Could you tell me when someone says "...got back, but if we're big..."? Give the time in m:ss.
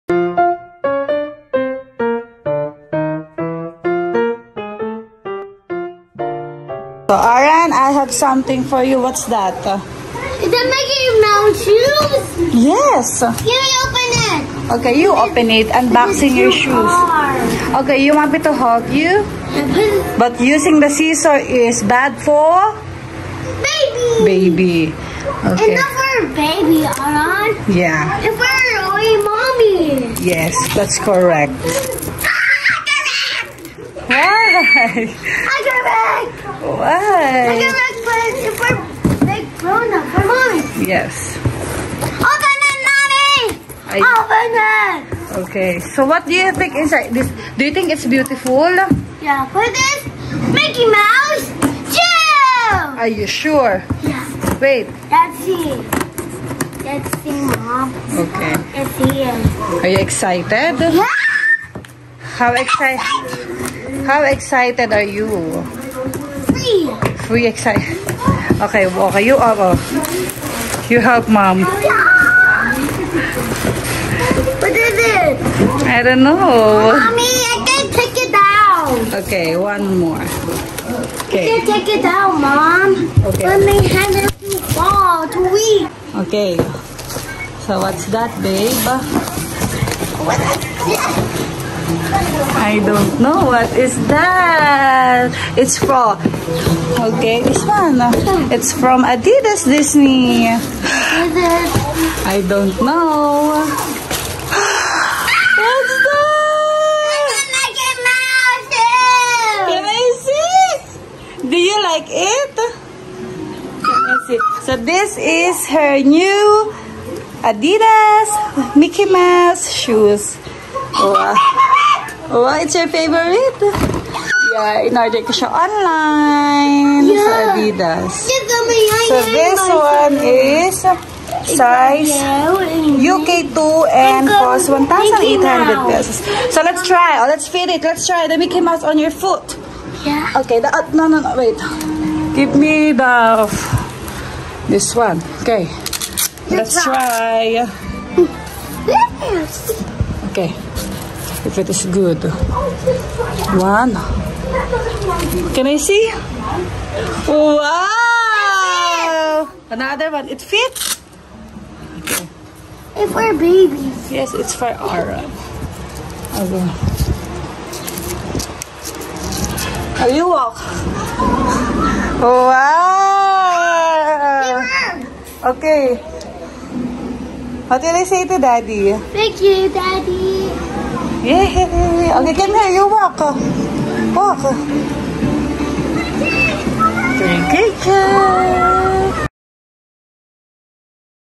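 0:37.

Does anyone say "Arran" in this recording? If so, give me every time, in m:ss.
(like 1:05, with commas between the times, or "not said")
0:07, 0:26.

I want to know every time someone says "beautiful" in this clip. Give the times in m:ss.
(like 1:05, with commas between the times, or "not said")
0:48.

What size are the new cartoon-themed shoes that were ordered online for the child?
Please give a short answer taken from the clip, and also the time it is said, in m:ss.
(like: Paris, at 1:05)
UK2, at 2:13.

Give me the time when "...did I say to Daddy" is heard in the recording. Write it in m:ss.
2:57.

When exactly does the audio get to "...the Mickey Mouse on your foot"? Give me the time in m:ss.
2:18.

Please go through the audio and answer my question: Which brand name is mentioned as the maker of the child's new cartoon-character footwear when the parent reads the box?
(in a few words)
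Adidas Disney.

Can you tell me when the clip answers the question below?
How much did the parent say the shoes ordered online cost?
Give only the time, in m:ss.
2:14.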